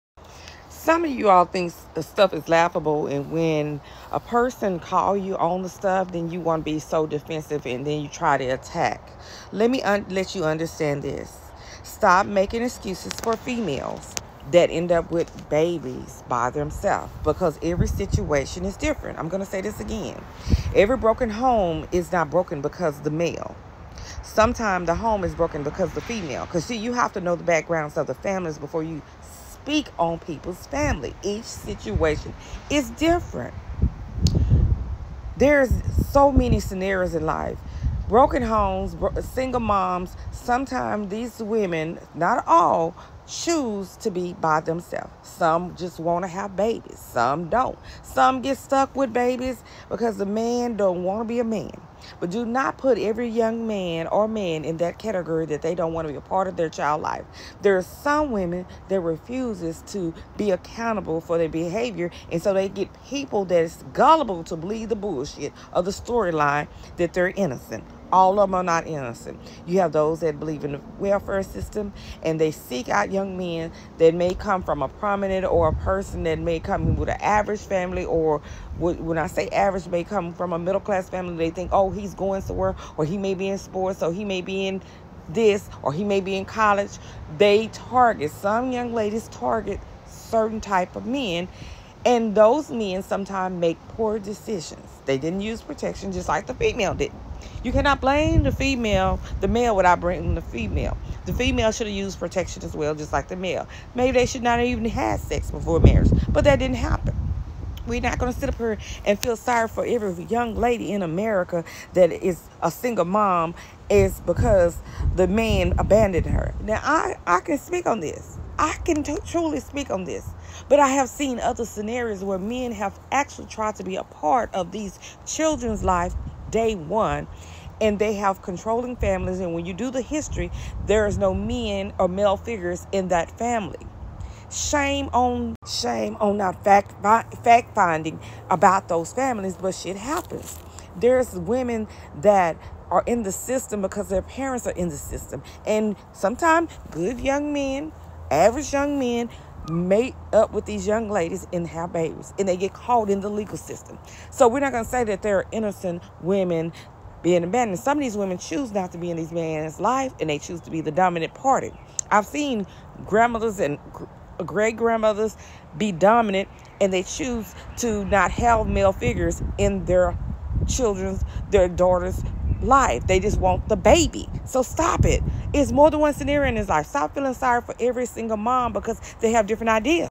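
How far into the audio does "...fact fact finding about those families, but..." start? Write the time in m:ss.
2:16.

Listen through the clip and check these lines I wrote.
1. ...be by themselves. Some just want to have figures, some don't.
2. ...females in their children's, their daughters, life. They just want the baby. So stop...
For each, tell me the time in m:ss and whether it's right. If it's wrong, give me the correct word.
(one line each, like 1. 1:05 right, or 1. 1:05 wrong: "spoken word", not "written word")
1. 0:44 wrong: "babies", not "figures"
2. 2:48 wrong: "figures", not "females".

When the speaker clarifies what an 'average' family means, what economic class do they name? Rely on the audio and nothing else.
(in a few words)
middle class.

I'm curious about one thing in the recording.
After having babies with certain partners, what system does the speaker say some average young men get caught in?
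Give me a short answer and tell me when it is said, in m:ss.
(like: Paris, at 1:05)
legal system, at 2:33.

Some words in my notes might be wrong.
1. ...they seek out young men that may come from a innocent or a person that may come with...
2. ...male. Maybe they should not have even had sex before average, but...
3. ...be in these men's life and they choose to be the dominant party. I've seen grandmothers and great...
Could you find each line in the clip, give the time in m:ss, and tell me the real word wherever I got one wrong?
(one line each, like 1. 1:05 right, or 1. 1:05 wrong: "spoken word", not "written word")
1. 1:12 wrong: "prominent", not "innocent"
2. 1:43 wrong: "marriage", not "average"
3. 2:38 right.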